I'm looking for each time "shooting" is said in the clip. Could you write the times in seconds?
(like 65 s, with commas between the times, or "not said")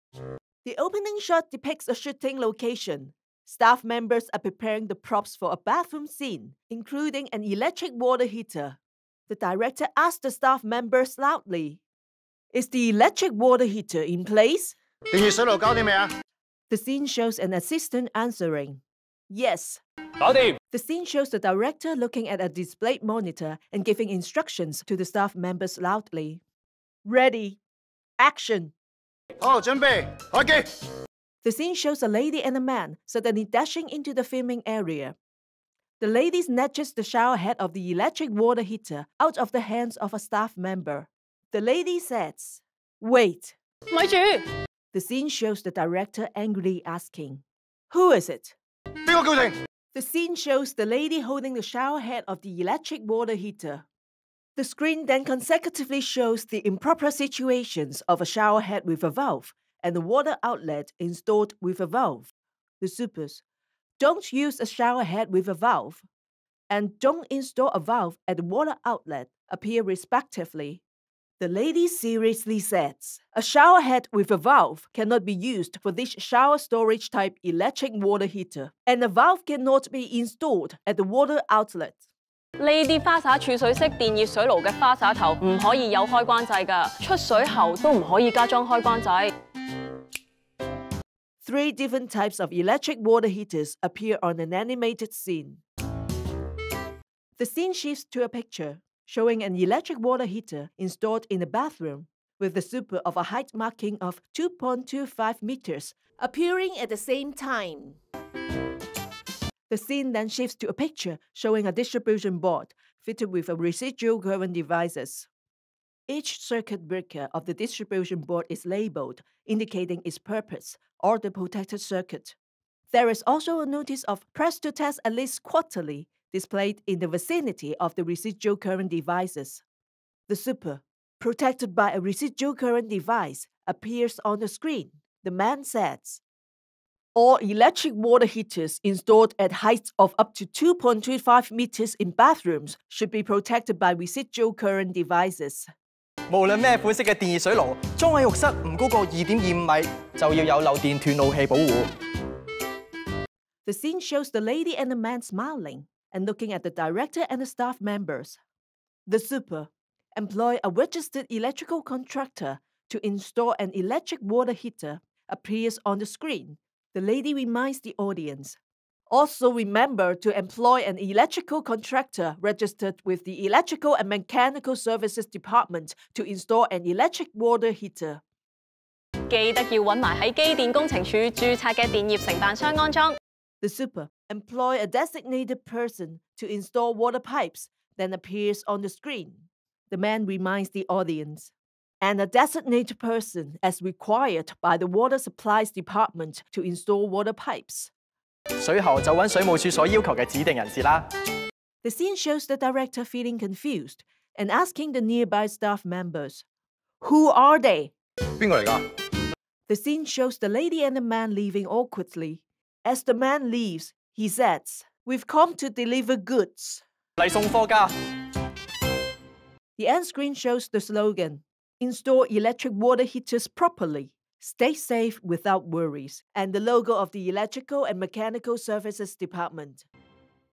1 s.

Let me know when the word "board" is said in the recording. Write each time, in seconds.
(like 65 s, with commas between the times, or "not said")
112 s, 118 s.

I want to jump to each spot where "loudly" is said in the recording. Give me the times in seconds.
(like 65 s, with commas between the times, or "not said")
11 s, 25 s.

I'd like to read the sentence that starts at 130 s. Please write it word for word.
The super, protected by a residual current device, appears on the screen.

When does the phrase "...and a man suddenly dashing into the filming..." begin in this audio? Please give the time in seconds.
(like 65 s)
32 s.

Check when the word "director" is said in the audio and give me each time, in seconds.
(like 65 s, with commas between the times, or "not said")
9 s, 21 s, 45 s, 156 s, 202 s.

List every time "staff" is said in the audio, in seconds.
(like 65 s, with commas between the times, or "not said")
3 s, 10 s, 25 s, 40 s, 157 s, 205 s.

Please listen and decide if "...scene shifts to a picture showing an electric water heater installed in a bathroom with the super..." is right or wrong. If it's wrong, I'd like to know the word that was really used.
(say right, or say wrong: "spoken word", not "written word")
right.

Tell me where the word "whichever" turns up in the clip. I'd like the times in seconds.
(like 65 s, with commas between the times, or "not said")
not said.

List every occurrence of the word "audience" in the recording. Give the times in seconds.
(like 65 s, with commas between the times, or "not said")
167 s, 190 s.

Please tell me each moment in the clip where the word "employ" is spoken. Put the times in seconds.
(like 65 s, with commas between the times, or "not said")
160 s, 170 s, 184 s.